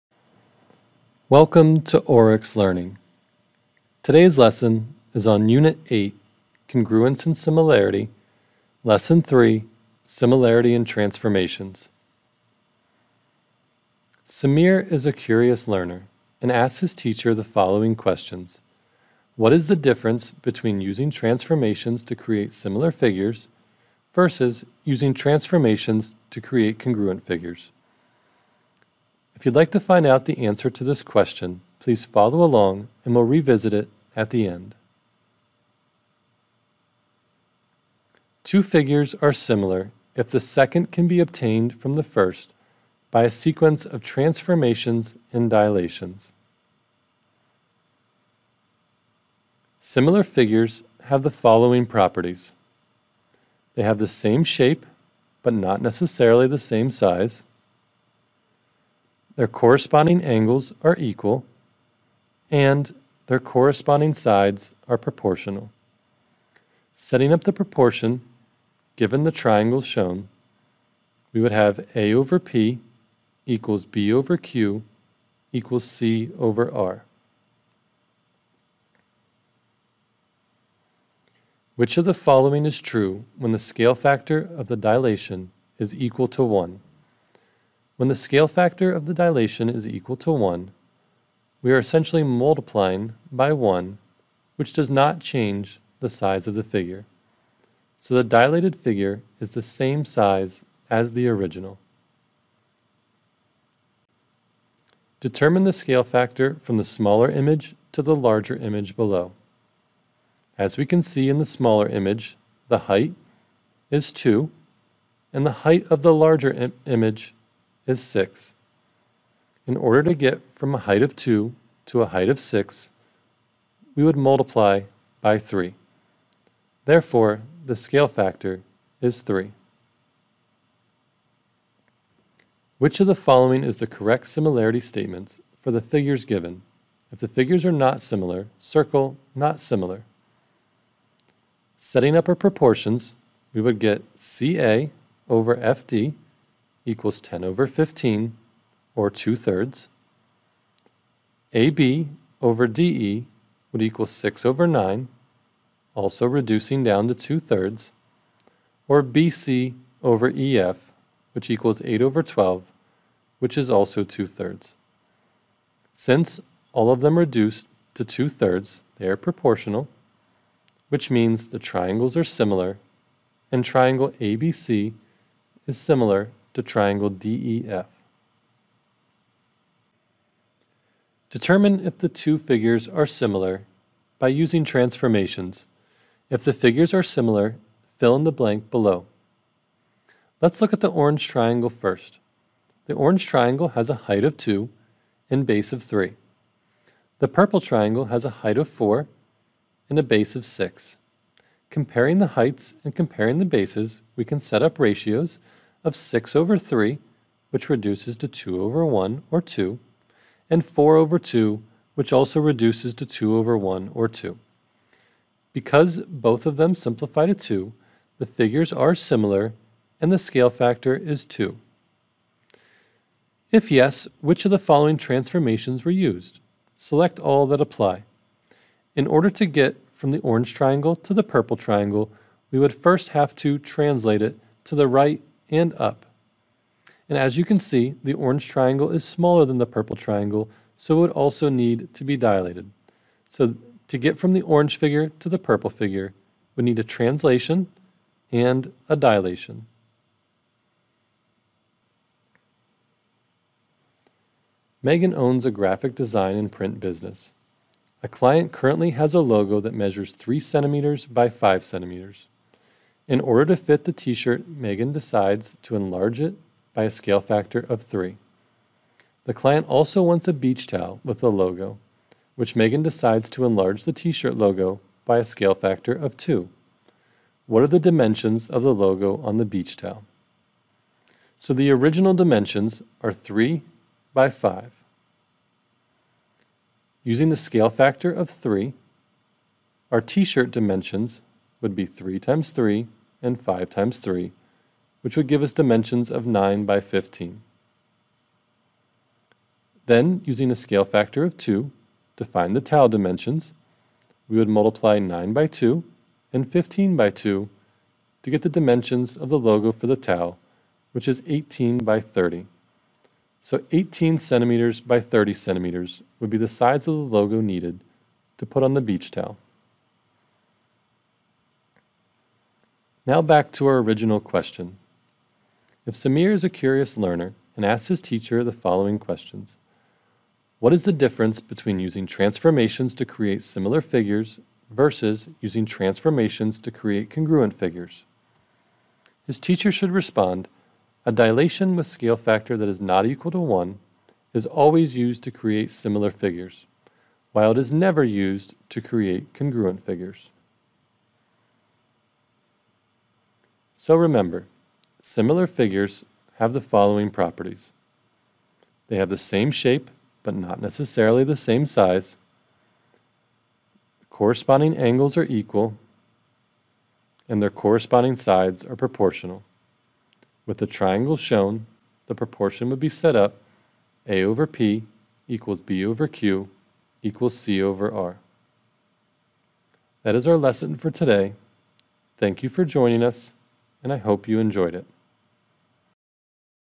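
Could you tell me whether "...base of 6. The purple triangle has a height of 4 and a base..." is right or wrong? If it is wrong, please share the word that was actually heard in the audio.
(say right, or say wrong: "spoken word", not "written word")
wrong: "3", not "6".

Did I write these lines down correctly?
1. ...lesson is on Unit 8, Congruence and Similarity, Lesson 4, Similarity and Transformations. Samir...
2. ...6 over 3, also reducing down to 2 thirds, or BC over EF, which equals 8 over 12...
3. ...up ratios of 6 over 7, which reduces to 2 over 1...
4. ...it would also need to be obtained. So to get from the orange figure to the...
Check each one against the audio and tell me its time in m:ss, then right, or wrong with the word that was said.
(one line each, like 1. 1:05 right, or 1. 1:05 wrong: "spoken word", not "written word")
1. 0:04 wrong: "3", not "4"
2. 2:34 wrong: "9", not "3"
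3. 3:24 wrong: "3", not "7"
4. 4:00 wrong: "dilated", not "obtained".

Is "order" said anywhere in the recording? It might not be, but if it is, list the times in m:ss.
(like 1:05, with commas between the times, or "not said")
1:59, 3:49, 4:23.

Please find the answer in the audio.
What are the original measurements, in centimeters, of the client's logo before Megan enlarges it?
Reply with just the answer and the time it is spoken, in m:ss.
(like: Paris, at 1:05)
3 by 5 centimeters, at 4:20.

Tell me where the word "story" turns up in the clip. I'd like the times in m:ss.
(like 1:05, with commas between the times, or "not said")
not said.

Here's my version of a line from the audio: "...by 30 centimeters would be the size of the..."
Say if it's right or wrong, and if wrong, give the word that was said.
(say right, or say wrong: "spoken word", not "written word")
right.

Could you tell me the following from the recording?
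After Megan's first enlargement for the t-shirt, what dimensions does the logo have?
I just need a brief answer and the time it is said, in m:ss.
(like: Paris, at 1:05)
9 by 15, at 4:56.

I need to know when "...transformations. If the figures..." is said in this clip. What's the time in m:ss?
3:04.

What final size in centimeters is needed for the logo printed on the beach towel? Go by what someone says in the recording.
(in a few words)
18 by 30.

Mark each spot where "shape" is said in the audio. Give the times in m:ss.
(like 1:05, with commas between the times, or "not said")
0:54, 5:59.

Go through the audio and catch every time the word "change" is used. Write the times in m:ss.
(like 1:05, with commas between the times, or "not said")
1:35.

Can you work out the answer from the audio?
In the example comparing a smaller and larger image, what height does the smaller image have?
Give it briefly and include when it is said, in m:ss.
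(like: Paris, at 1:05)
2, at 1:52.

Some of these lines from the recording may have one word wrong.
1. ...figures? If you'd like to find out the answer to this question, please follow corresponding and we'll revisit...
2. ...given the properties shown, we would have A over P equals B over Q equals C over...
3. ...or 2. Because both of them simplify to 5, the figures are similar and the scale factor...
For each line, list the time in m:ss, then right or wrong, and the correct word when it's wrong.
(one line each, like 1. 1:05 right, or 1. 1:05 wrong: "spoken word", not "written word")
1. 0:27 wrong: "along", not "corresponding"
2. 1:08 wrong: "triangles", not "properties"
3. 3:33 wrong: "2", not "5".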